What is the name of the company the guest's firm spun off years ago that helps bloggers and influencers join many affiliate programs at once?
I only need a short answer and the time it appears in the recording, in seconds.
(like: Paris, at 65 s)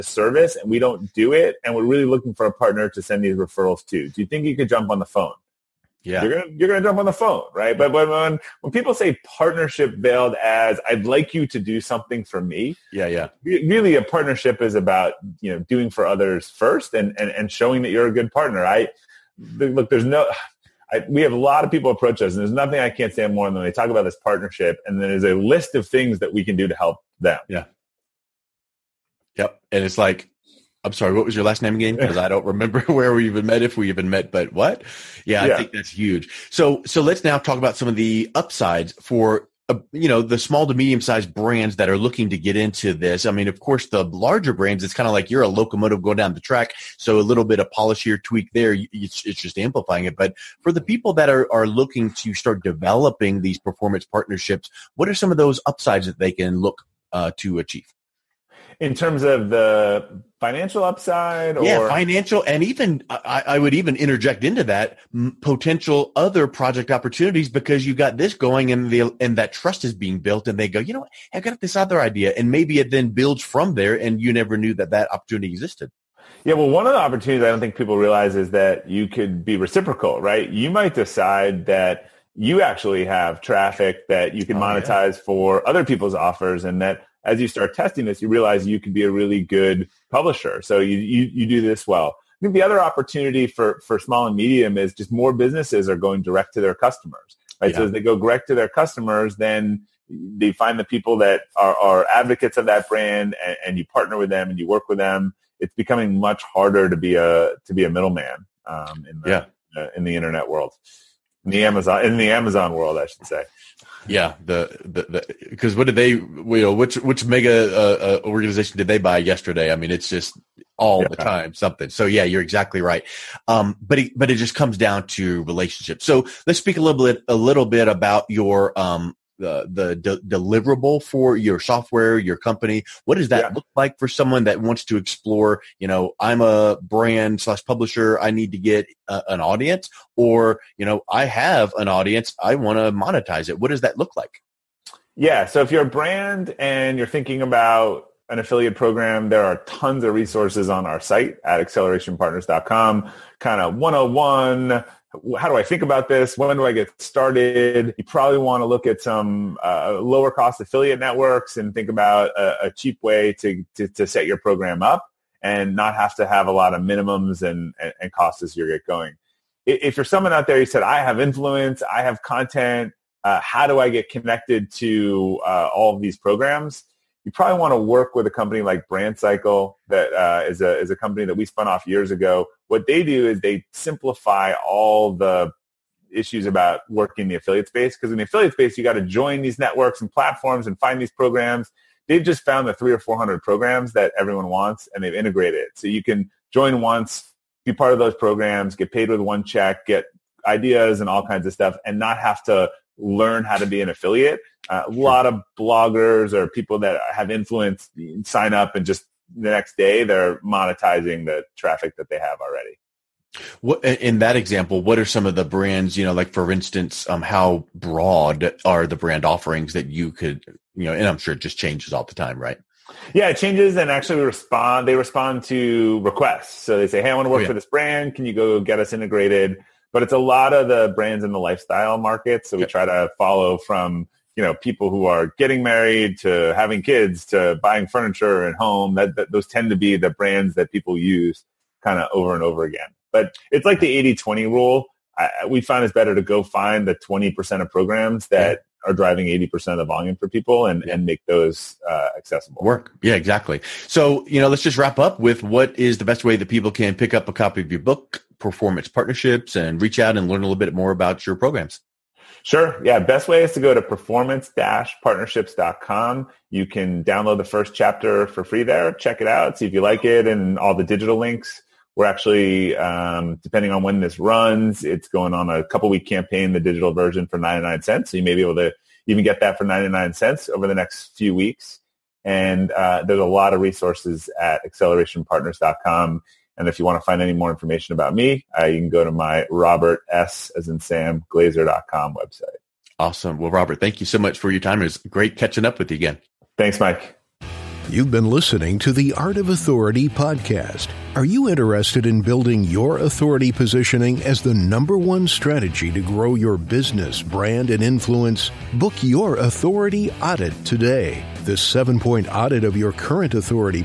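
BrandCycle, at 178 s.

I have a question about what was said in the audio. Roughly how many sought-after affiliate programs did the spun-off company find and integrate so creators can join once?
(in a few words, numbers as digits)
300 or 400.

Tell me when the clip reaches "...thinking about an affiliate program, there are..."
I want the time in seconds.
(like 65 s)
147 s.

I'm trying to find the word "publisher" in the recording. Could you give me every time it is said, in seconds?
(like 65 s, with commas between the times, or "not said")
90 s, 137 s.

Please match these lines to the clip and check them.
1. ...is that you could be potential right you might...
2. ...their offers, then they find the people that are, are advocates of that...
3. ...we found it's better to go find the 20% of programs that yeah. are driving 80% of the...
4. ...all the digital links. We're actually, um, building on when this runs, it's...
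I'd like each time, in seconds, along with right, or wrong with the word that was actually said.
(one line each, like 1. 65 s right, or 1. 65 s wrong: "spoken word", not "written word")
1. 78 s wrong: "reciprocal", not "potential"
2. 98 s wrong: "customers", not "offers"
3. 245 s right
4. 270 s wrong: "depending", not "building".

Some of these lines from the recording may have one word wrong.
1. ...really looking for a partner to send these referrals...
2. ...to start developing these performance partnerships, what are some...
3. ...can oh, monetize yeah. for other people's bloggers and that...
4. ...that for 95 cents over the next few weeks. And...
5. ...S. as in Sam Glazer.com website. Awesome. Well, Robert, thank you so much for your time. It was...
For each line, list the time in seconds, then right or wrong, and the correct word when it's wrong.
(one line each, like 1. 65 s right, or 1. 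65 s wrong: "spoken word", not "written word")
1. 1 s right
2. 52 s right
3. 84 s wrong: "offers", not "bloggers"
4. 279 s wrong: "99", not "95"
5. 290 s right.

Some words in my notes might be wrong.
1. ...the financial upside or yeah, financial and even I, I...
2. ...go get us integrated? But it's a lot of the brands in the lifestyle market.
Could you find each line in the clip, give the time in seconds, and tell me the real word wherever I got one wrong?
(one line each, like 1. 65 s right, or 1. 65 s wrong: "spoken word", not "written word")
1. 59 s right
2. 228 s right.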